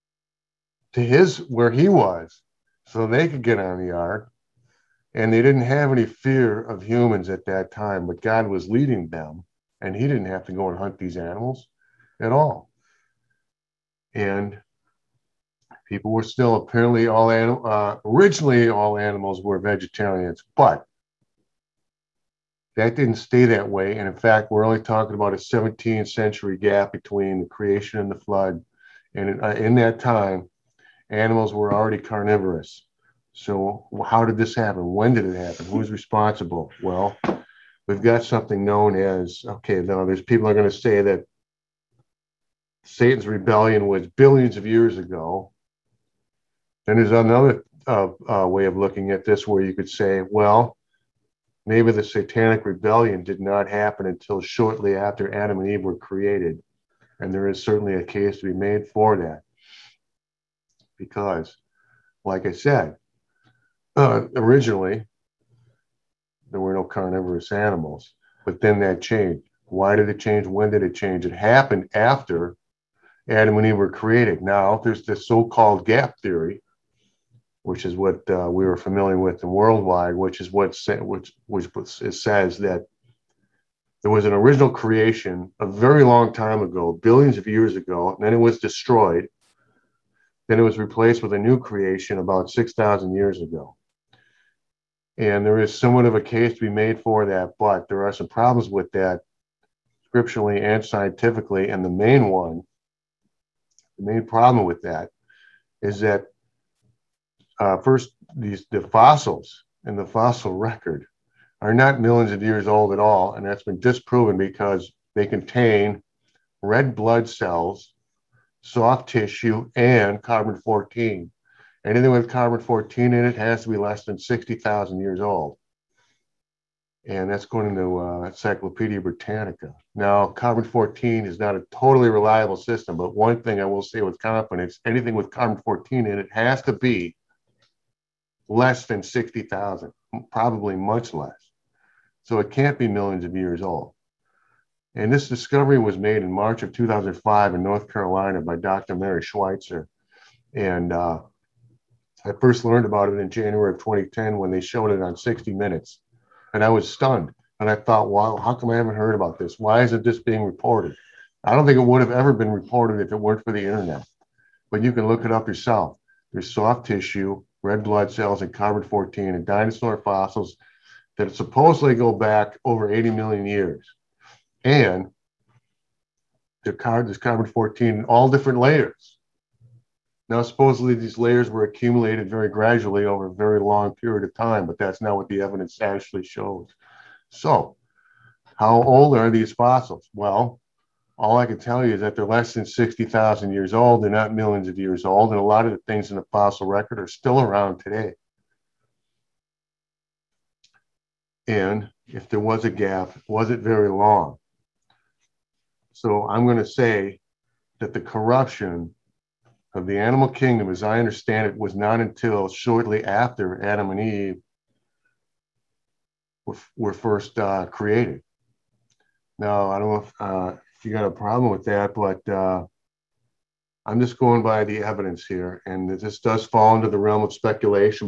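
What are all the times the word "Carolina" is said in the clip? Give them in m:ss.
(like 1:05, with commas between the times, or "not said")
2:27.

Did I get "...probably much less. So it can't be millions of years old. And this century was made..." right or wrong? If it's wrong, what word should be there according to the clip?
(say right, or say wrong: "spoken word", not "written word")
wrong: "discovery", not "century".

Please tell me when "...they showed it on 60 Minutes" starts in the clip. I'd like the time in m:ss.
2:34.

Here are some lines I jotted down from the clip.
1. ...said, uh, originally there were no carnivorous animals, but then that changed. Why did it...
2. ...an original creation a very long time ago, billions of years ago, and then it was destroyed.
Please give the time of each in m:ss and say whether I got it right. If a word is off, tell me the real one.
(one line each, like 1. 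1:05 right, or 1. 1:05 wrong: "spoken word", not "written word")
1. 1:02 right
2. 1:24 right.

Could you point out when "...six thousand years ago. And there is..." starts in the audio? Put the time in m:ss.
1:32.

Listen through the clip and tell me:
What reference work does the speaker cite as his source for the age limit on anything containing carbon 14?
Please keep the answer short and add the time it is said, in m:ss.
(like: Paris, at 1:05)
Encyclopedia Britannica, at 2:08.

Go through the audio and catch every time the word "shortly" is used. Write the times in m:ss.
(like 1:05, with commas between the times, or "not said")
0:54, 3:32.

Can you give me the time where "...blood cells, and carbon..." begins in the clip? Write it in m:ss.
2:47.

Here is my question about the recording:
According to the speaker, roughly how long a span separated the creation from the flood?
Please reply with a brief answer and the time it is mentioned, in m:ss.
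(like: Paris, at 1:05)
17th century, at 0:25.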